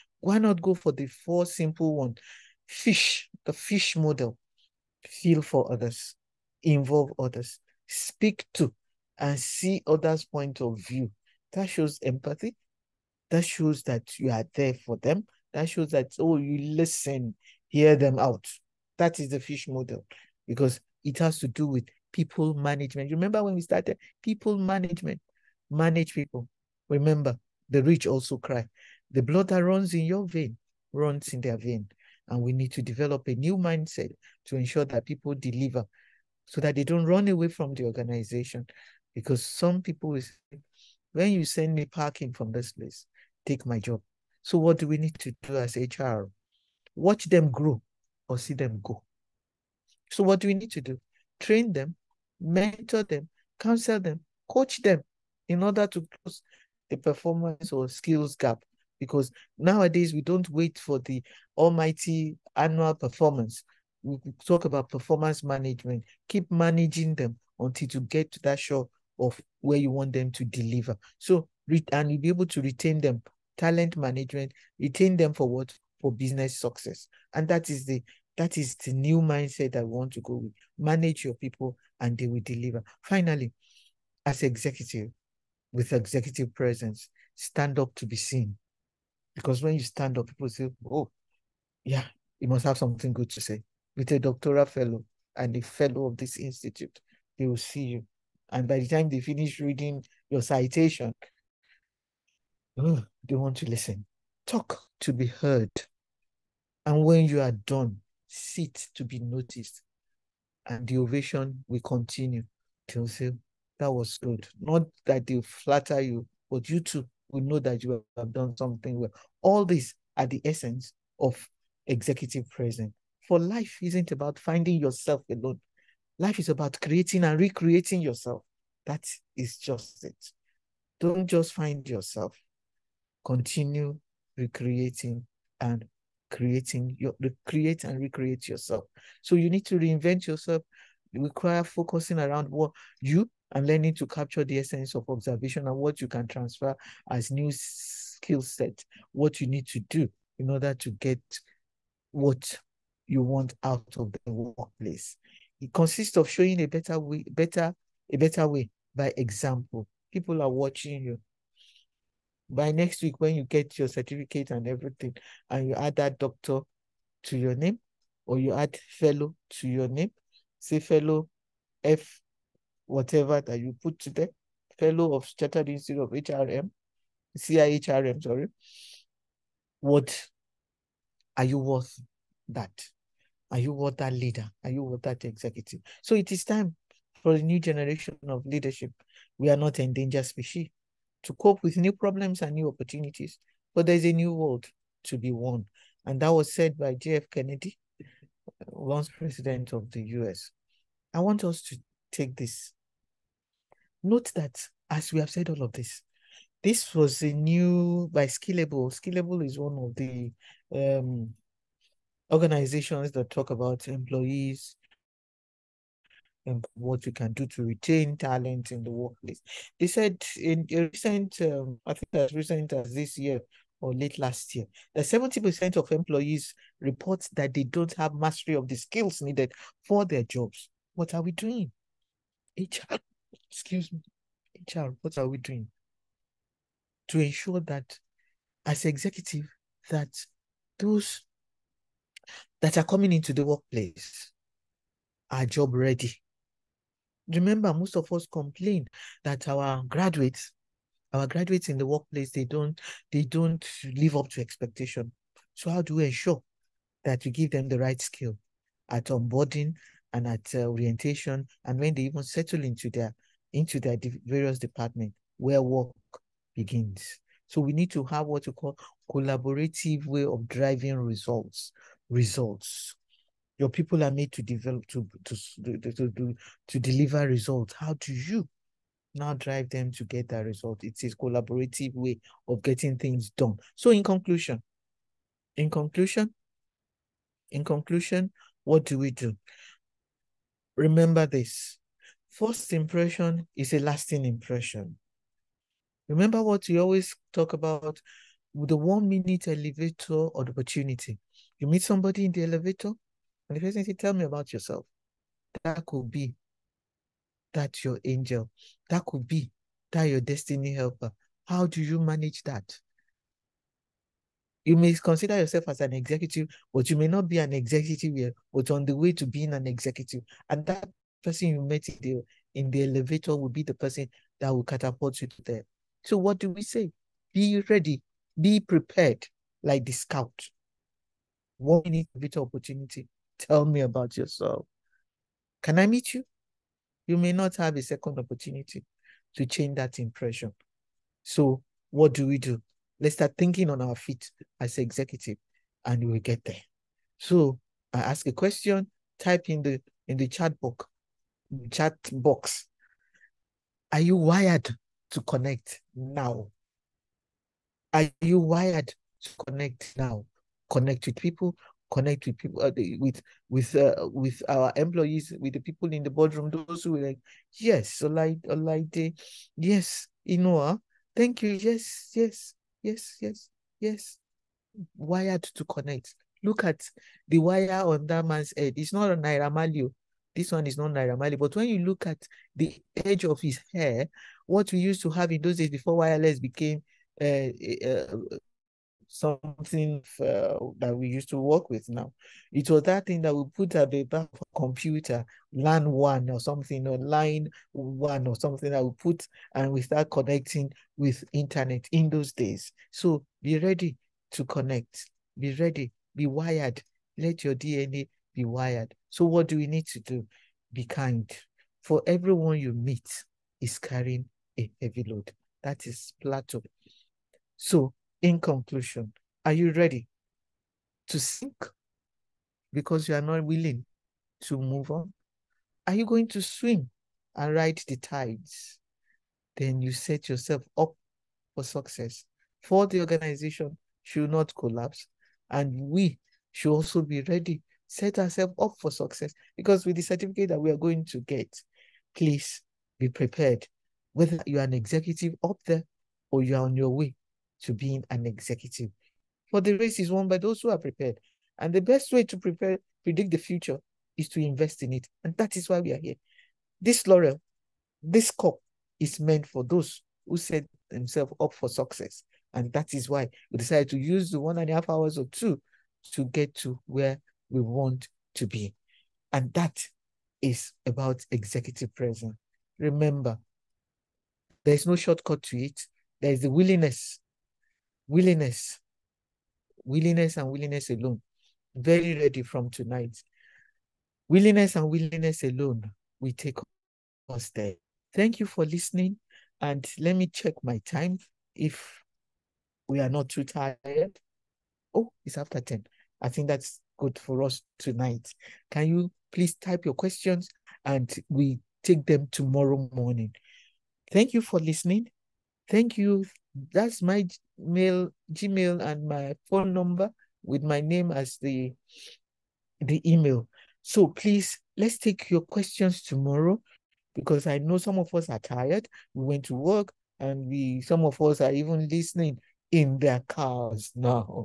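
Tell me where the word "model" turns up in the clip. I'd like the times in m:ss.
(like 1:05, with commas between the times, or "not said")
0:03, 0:19.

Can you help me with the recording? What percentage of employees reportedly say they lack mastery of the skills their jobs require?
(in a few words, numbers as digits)
70%.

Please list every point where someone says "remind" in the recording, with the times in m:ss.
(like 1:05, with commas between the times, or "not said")
not said.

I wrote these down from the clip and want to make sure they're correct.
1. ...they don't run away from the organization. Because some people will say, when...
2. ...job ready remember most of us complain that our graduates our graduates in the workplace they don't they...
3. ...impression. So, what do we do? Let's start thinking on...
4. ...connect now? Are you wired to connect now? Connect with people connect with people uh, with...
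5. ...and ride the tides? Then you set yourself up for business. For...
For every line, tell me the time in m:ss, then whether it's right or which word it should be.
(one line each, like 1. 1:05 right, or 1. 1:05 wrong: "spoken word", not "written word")
1. 0:36 right
2. 4:05 right
3. 5:39 right
4. 5:55 right
5. 7:07 wrong: "success", not "business".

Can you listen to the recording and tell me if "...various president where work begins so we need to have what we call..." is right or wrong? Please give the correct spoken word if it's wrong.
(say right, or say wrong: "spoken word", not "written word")
wrong: "department", not "president".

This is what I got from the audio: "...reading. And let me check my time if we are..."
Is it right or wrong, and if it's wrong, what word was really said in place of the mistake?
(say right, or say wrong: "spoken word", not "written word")
wrong: "listening", not "reading".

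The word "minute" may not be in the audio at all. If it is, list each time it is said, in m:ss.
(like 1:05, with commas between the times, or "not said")
4:59, 5:31.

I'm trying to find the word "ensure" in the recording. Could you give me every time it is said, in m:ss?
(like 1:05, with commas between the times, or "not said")
0:34, 3:57, 4:16.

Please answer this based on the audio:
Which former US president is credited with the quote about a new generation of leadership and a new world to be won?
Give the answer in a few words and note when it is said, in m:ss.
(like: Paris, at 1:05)
J.F. Kennedy, at 3:16.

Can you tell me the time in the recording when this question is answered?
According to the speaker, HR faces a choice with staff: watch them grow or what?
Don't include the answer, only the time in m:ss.
0:48.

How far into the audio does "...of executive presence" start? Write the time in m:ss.
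2:01.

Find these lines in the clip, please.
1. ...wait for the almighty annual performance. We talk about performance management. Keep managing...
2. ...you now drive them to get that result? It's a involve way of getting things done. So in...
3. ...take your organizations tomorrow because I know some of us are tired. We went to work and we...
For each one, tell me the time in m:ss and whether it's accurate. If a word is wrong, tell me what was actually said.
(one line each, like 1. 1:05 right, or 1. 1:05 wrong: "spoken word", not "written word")
1. 1:00 right
2. 4:38 wrong: "collaborative", not "involve"
3. 8:34 wrong: "questions", not "organizations".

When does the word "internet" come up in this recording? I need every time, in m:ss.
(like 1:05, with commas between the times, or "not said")
6:41.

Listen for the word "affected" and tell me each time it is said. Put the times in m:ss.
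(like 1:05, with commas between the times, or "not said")
not said.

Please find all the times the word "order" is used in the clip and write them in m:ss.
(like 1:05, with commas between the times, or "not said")
0:55, 2:30.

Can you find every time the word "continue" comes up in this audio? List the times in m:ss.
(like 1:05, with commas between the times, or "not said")
1:51, 2:13.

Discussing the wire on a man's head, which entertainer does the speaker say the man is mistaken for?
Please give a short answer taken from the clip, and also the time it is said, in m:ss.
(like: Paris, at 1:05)
Naira Marley, at 6:19.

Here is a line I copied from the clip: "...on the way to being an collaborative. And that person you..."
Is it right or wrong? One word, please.
wrong.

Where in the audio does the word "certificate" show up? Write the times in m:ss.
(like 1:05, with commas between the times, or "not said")
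2:43, 7:20.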